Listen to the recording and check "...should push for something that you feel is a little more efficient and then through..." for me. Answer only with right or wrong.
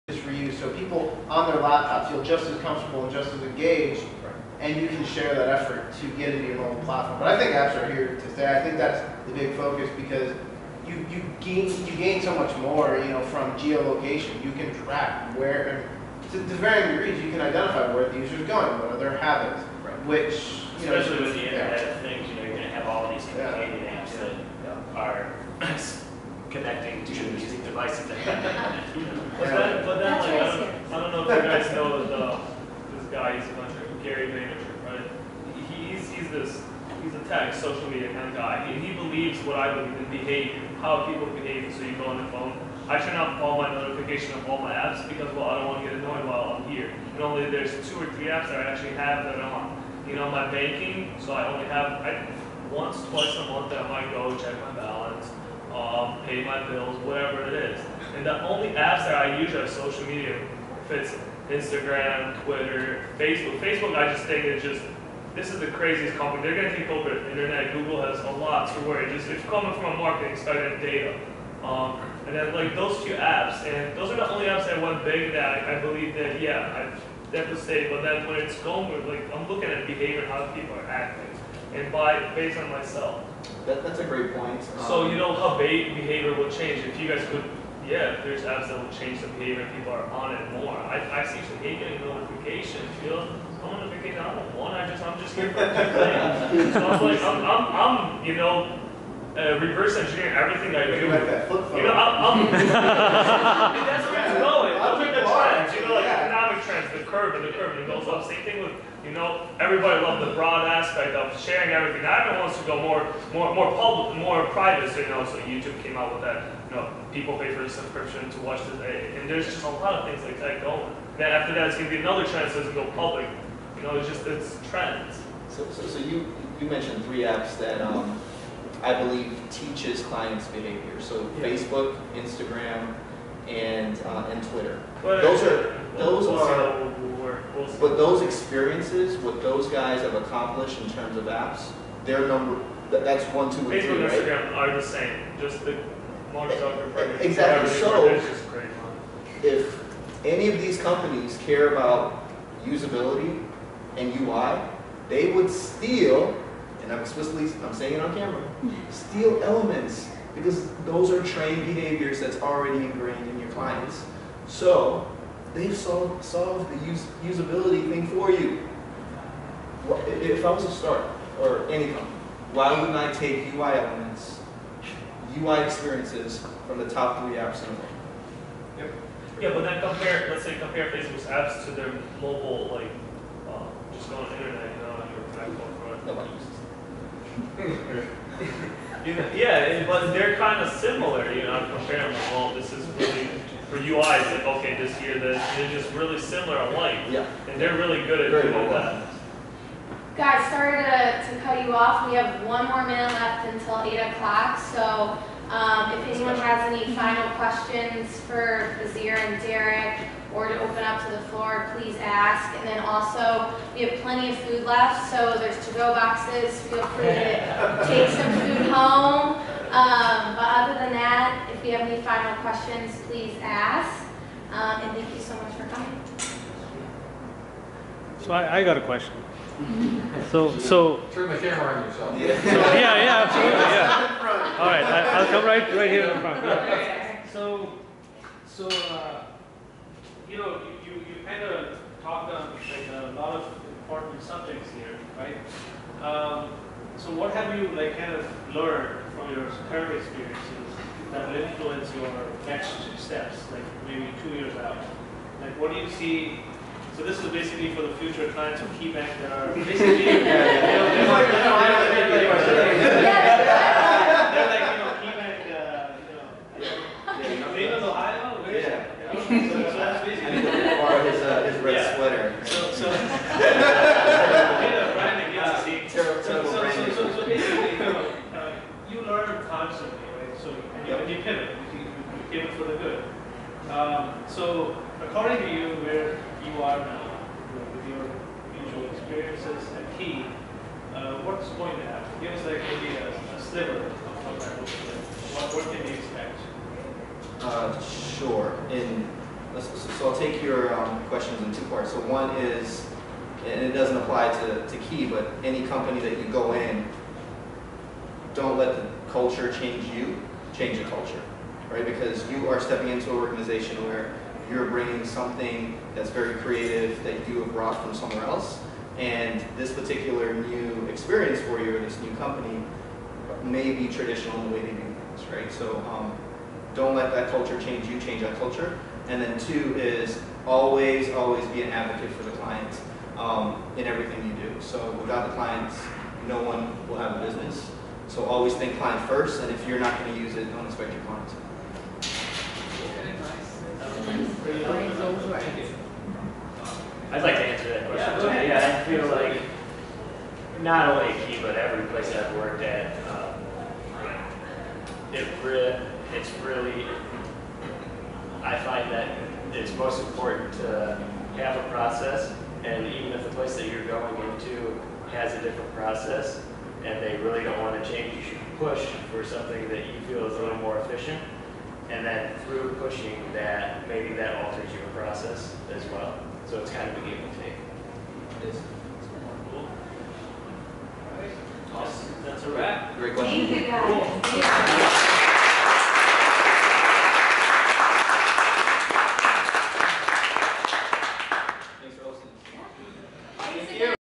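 right.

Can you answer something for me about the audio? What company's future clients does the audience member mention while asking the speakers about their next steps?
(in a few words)
KeyBank.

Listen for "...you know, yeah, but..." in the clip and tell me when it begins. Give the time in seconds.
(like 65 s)
189 s.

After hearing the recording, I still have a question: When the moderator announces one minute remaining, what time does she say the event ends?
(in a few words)
8 o'clock.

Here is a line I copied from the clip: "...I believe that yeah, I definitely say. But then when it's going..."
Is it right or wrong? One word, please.
right.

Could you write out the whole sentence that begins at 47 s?
And only there's two or three apps that I actually have that I'm on.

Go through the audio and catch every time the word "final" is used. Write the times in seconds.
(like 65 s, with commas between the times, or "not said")
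206 s, 222 s.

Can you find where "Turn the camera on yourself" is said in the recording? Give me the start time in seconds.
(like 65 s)
231 s.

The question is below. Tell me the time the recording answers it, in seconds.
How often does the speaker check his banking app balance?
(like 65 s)
52 s.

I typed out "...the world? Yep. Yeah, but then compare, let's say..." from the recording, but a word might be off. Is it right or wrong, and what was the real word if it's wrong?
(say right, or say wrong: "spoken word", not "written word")
right.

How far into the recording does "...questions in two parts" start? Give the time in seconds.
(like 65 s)
301 s.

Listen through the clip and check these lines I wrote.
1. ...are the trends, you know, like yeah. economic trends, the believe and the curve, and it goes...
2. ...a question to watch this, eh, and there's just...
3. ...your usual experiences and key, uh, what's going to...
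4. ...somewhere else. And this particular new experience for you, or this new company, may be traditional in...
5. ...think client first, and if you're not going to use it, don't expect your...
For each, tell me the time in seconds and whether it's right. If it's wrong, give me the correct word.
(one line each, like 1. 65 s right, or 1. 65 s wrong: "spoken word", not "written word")
1. 105 s wrong: "curve", not "believe"
2. 117 s wrong: "subscription", not "question"
3. 287 s right
4. 317 s right
5. 338 s right.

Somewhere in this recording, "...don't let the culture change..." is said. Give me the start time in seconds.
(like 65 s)
308 s.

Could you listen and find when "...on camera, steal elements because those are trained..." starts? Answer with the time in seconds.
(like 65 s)
157 s.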